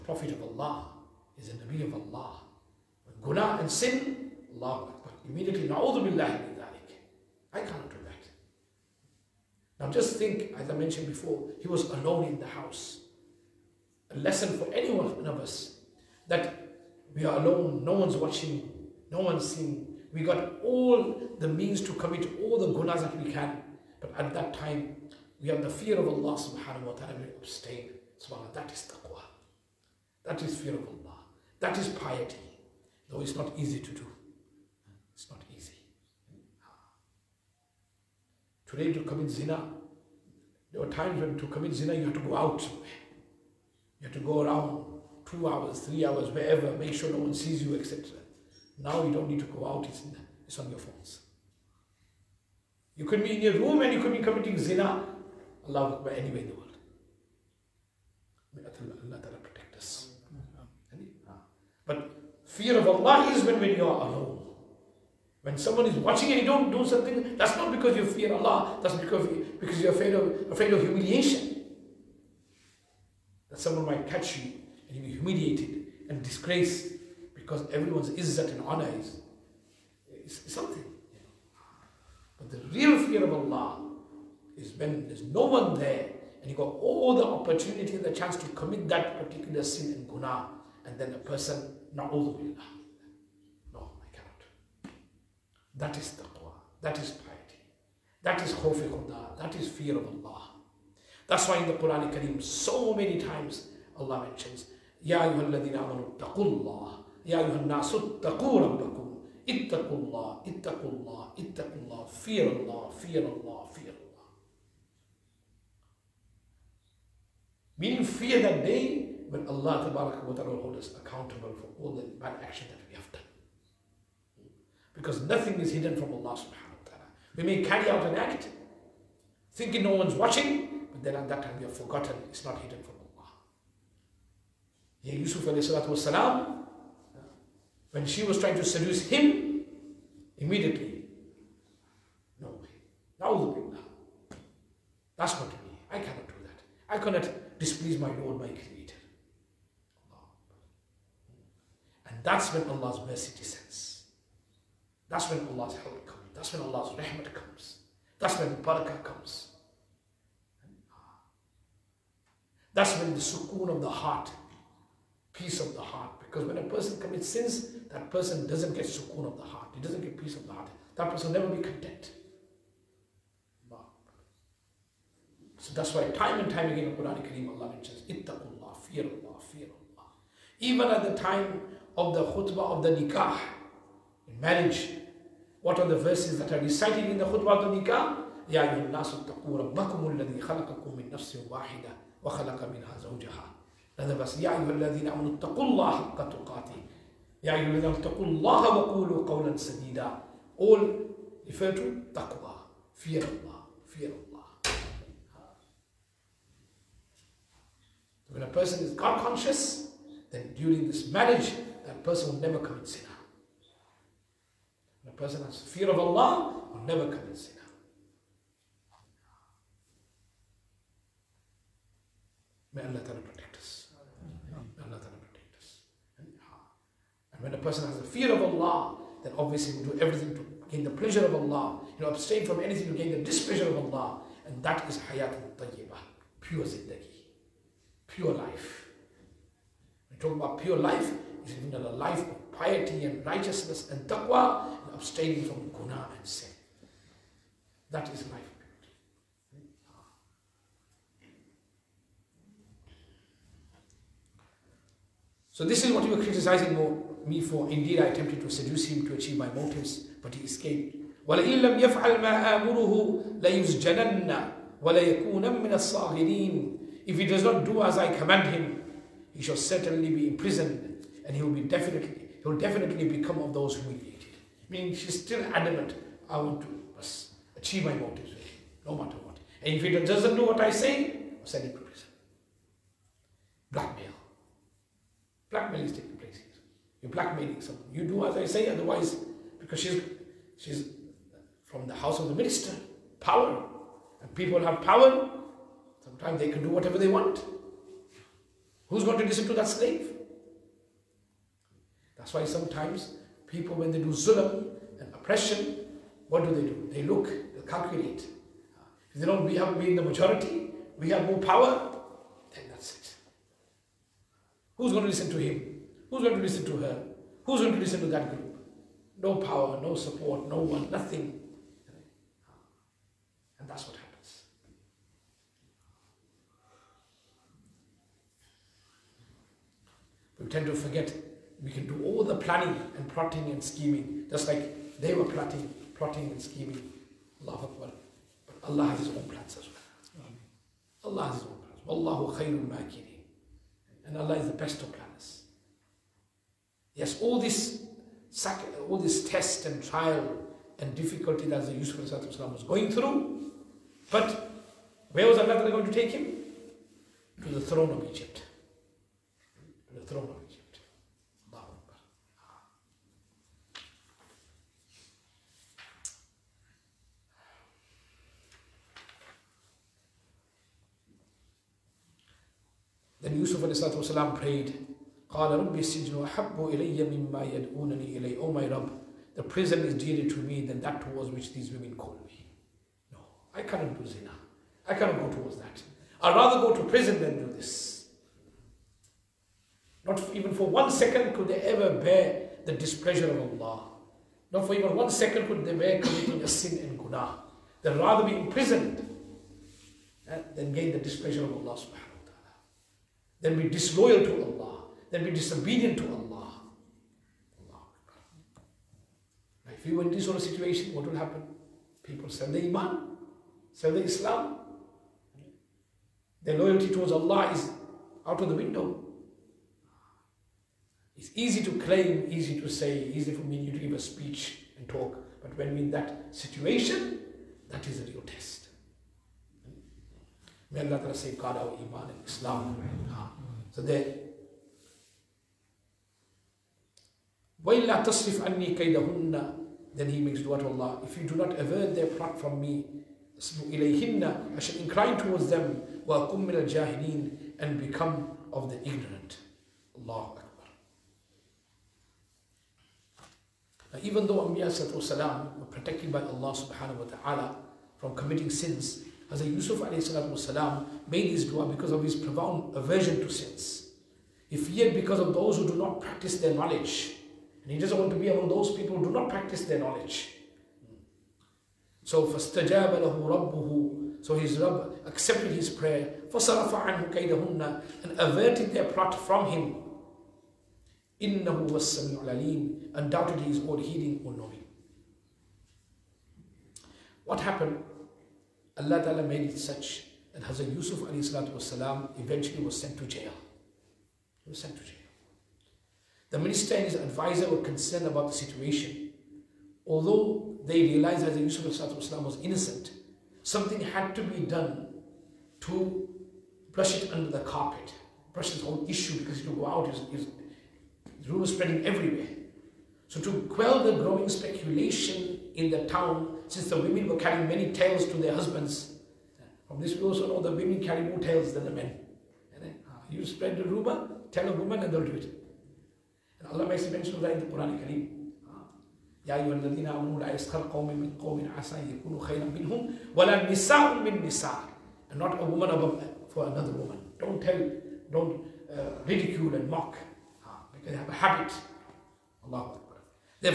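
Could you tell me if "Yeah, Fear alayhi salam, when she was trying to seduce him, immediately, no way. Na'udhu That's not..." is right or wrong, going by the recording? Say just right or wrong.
wrong.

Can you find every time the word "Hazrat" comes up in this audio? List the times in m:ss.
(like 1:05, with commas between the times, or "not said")
7:39, 8:10.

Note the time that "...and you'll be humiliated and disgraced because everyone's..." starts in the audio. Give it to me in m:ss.
1:14.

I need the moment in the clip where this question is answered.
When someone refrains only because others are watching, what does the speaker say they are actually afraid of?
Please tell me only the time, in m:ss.
1:10.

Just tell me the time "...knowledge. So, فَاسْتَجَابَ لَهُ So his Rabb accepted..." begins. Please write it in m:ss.
7:49.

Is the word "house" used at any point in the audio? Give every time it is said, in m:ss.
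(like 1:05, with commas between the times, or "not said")
0:12, 4:51.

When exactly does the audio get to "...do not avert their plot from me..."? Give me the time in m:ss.
7:21.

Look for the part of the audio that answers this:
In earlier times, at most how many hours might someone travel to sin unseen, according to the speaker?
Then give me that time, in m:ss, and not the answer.
0:45.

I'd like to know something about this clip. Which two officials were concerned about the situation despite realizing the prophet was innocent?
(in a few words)
The minister and his advisor.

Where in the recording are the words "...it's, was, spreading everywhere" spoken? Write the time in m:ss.
8:29.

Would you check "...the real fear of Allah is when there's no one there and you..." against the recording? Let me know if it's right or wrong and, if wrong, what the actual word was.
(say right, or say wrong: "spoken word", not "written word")
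right.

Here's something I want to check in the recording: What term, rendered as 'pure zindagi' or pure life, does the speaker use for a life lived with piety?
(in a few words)
hayat al-tayyibah.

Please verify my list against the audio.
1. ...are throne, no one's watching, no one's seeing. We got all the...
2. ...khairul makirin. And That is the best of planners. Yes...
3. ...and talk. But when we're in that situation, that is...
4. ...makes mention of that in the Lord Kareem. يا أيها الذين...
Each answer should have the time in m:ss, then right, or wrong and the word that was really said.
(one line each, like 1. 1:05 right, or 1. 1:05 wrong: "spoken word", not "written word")
1. 0:17 wrong: "alone", not "throne"
2. 5:42 wrong: "Allah", not "That"
3. 7:04 right
4. 8:46 wrong: "Quran", not "Lord".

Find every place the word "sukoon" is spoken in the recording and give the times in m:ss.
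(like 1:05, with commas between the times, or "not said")
2:43, 2:48.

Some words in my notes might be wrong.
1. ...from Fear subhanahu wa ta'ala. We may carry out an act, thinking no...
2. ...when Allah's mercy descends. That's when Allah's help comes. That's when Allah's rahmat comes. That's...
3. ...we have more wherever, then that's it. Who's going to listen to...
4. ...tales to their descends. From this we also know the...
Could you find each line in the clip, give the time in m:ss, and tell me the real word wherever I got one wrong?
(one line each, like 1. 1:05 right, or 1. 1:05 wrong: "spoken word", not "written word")
1. 2:05 wrong: "Allah", not "Fear"
2. 2:32 right
3. 5:10 wrong: "power", not "wherever"
4. 8:37 wrong: "husbands", not "descends".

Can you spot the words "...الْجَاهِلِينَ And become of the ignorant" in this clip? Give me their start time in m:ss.
7:26.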